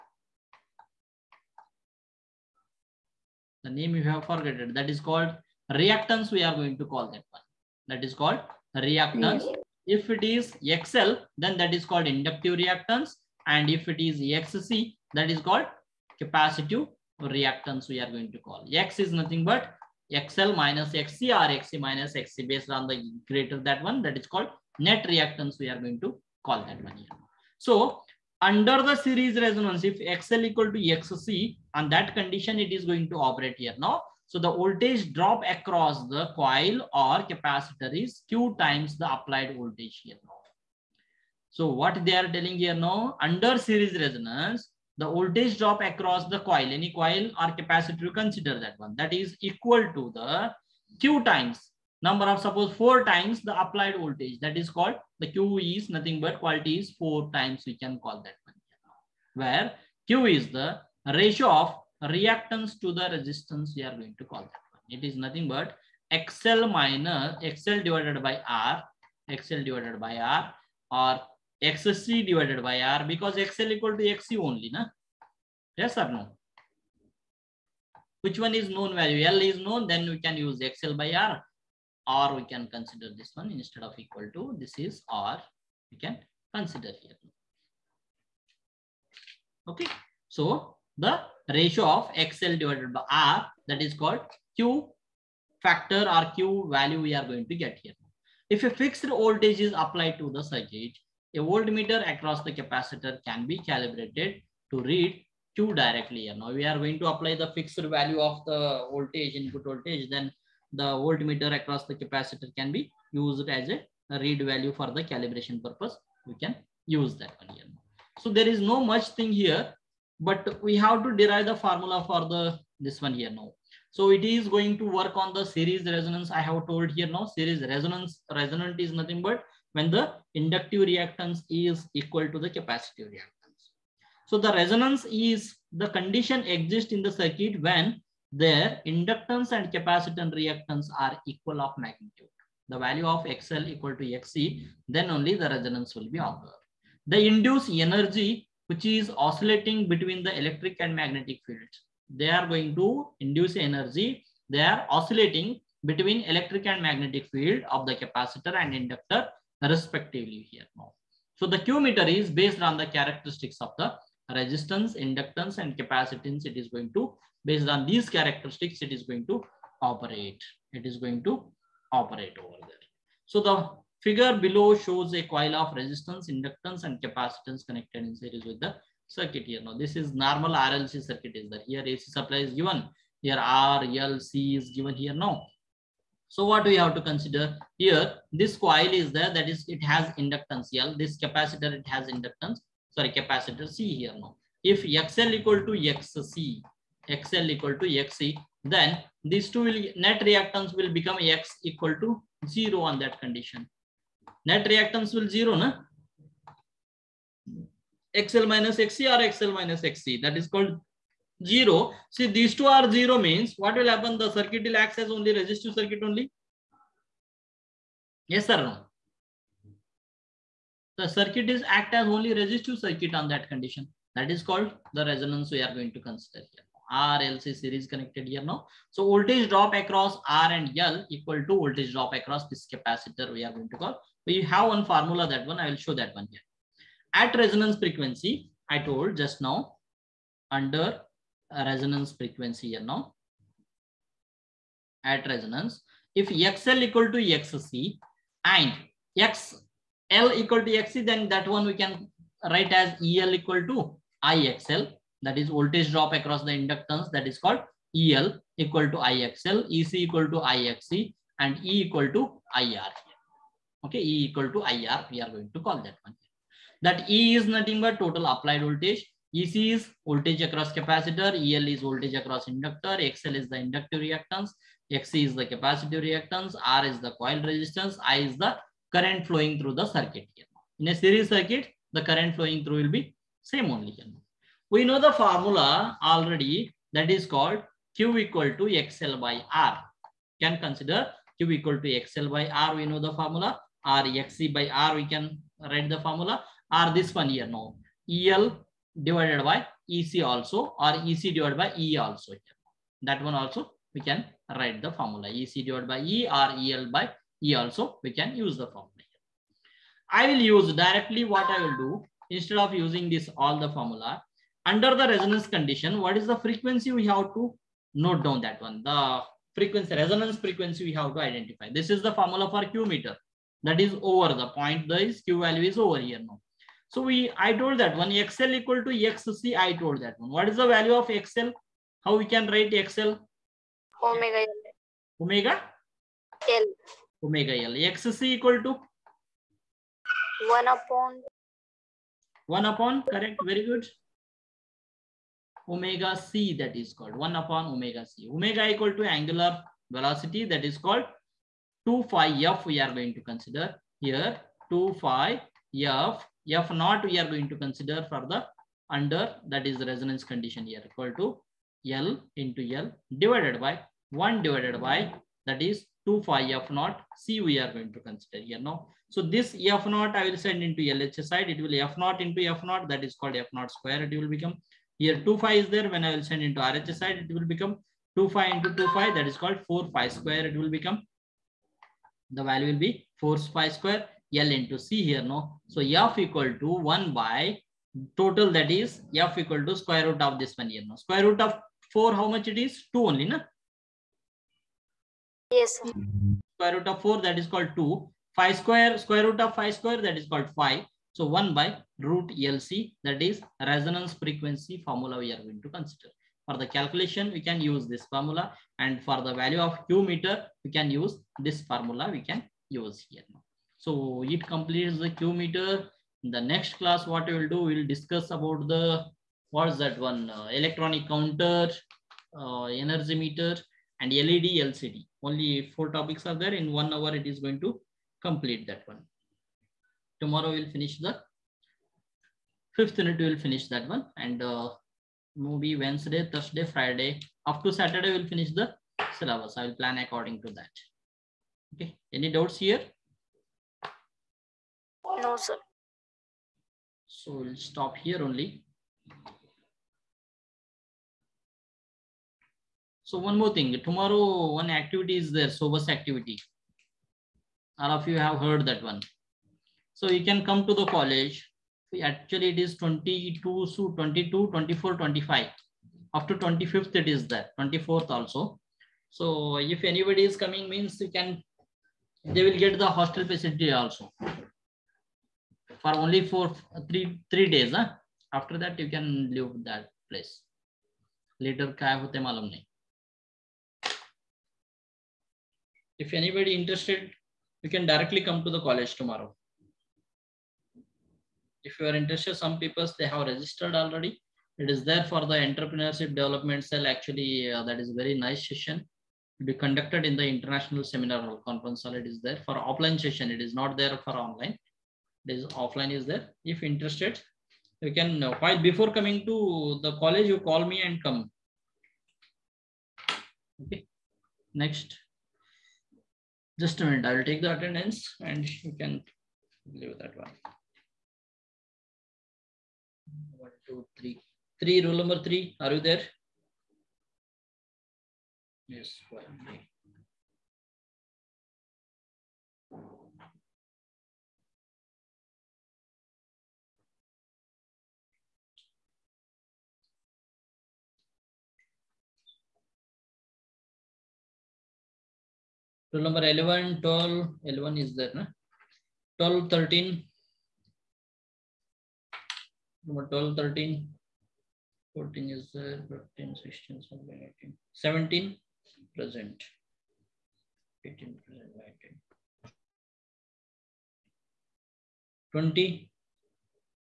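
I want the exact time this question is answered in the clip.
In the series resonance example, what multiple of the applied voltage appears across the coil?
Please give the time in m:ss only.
0:52.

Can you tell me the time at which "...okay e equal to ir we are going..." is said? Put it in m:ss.
4:23.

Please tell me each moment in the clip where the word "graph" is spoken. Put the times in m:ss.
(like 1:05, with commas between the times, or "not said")
not said.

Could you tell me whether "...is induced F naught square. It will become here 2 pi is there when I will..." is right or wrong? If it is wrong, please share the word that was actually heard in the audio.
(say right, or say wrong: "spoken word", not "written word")
wrong: "called", not "induced".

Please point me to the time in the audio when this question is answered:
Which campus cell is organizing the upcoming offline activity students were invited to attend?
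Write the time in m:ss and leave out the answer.
8:15.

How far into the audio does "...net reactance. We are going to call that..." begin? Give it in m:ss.
0:24.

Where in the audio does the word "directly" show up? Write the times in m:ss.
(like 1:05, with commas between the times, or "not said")
1:45, 5:10, 8:07.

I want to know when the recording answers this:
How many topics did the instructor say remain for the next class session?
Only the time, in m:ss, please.
7:05.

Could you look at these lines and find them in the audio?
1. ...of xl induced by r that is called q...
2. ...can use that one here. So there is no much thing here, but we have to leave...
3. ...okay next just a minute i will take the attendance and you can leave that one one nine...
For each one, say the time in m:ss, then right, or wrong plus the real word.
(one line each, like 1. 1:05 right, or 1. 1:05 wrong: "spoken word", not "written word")
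1. 1:31 wrong: "divided", not "induced"
2. 1:56 wrong: "derive", not "leave"
3. 8:33 wrong: "two", not "nine".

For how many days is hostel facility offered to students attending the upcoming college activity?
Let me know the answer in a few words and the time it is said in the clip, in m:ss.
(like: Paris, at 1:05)
3, at 7:56.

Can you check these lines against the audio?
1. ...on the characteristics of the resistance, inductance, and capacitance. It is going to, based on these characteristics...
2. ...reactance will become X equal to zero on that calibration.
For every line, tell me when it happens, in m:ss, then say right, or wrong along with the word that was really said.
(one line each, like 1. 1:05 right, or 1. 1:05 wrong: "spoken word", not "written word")
1. 2:42 right
2. 3:20 wrong: "condition", not "calibration".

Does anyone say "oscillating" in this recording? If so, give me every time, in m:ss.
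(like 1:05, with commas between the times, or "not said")
2:29, 2:34.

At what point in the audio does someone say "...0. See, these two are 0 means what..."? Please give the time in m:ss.
3:31.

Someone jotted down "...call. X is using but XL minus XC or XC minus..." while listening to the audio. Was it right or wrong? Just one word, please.
wrong.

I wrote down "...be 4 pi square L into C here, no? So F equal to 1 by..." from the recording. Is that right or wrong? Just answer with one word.
right.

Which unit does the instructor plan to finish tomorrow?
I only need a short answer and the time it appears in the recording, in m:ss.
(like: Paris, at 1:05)
fifth unit, at 7:12.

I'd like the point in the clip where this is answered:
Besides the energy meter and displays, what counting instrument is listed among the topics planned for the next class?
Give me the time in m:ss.
7:00.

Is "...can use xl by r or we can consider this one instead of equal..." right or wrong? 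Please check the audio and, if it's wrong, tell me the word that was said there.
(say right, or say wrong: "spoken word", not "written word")
right.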